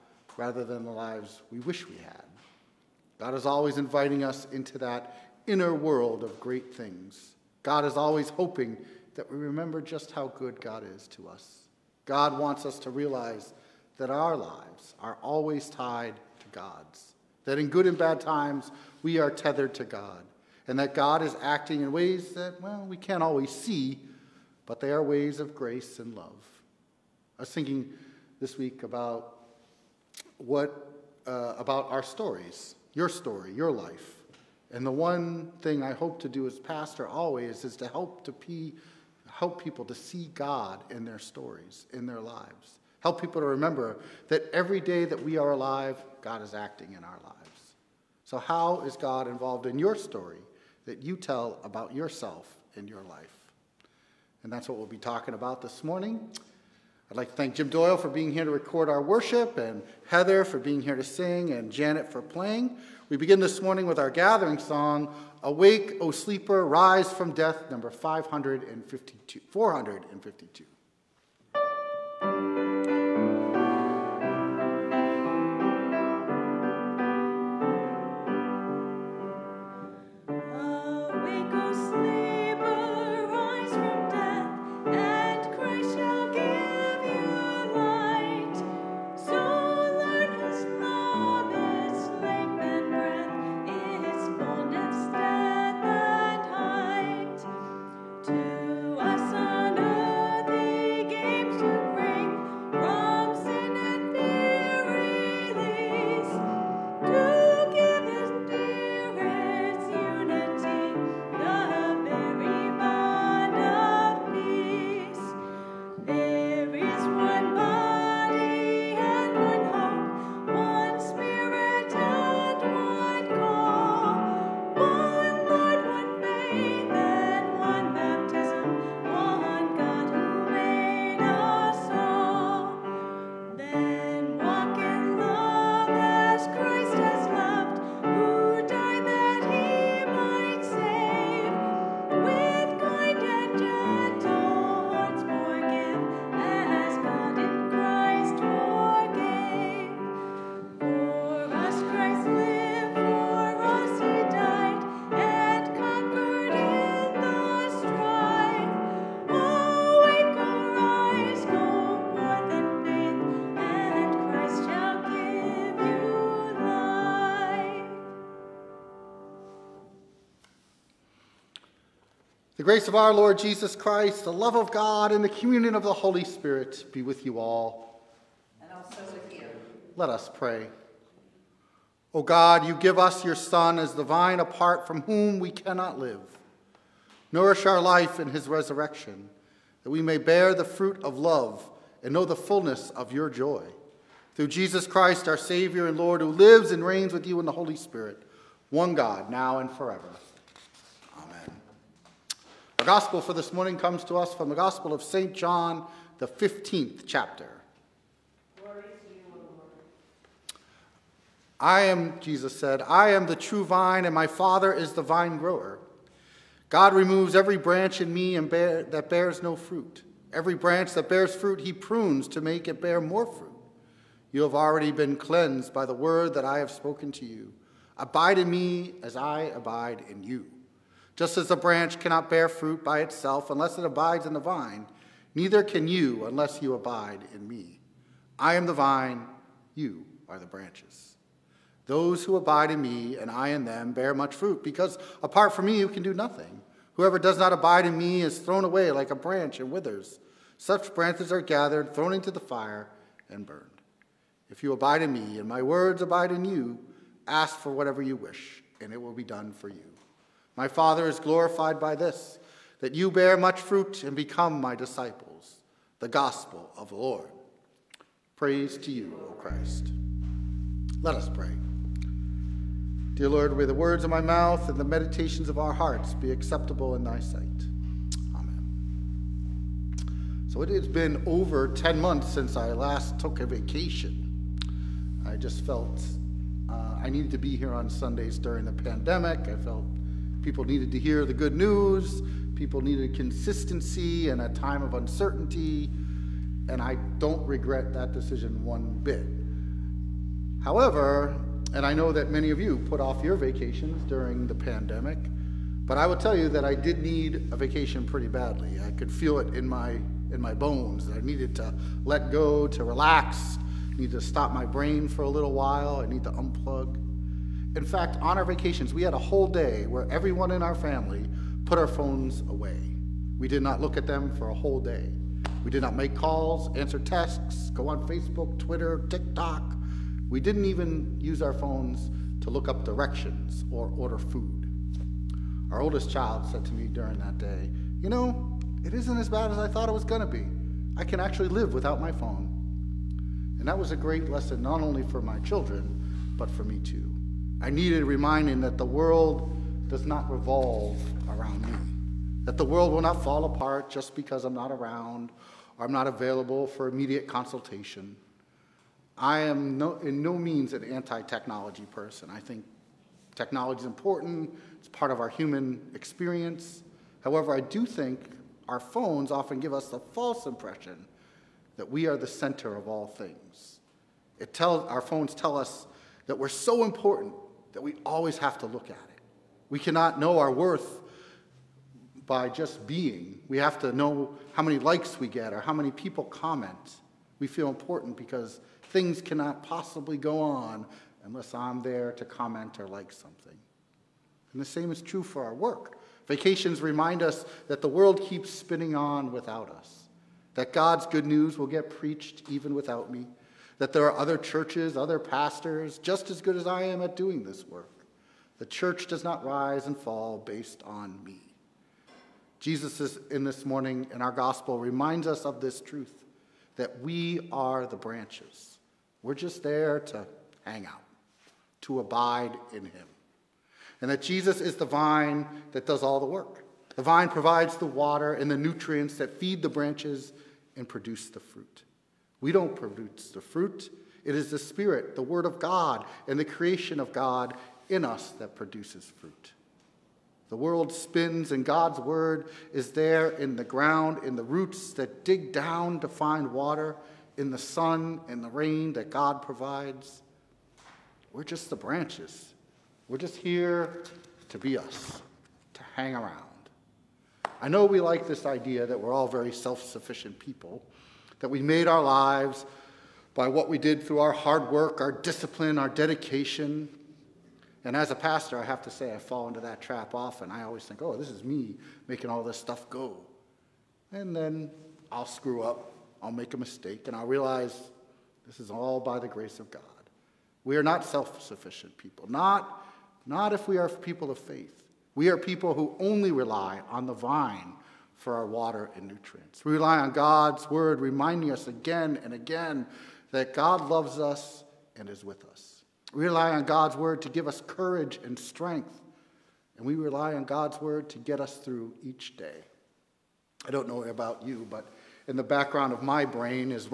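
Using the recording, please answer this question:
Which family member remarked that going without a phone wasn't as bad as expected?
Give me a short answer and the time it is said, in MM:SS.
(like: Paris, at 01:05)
oldest child, at 05:35.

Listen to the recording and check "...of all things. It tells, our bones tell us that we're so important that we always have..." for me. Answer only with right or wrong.
wrong.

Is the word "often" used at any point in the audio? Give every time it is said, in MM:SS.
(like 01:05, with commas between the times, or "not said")
06:09, 07:50.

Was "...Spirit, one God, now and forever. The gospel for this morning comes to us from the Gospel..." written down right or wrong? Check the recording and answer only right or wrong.
right.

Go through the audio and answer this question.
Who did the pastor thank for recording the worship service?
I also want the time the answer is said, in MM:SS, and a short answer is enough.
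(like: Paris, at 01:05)
Jim Doyle, at 00:57.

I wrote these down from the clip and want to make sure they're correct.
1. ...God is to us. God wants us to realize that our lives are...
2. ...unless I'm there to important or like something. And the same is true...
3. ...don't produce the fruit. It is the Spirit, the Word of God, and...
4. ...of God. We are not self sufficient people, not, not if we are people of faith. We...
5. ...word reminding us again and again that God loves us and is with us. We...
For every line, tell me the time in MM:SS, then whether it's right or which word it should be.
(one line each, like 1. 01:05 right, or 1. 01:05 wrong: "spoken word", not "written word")
1. 00:10 right
2. 06:31 wrong: "comment", not "important"
3. 07:12 right
4. 07:59 right
5. 08:10 right.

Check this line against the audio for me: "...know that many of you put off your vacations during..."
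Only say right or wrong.
right.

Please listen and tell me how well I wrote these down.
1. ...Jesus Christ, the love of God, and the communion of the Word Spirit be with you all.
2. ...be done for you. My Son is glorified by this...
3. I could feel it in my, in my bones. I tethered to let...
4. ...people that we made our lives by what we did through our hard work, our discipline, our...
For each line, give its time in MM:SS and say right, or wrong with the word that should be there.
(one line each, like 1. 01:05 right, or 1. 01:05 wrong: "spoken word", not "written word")
1. 02:53 wrong: "Holy", not "Word"
2. 04:19 wrong: "Father", not "Son"
3. 05:08 wrong: "needed", not "tethered"
4. 07:40 right.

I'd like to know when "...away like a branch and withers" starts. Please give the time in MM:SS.
04:08.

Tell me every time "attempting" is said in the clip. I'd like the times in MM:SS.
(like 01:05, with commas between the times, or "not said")
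not said.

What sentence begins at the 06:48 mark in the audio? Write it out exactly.
The church does not rise and fall based on me.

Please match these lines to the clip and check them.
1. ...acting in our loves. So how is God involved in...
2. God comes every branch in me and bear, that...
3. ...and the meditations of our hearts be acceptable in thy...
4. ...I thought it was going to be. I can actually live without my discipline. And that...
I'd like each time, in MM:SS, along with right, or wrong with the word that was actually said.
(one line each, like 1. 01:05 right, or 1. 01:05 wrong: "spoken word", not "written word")
1. 00:46 wrong: "lives", not "loves"
2. 03:36 wrong: "removes", not "comes"
3. 04:34 right
4. 05:39 wrong: "phone", not "discipline".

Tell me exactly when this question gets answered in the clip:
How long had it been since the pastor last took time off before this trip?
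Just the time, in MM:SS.
04:41.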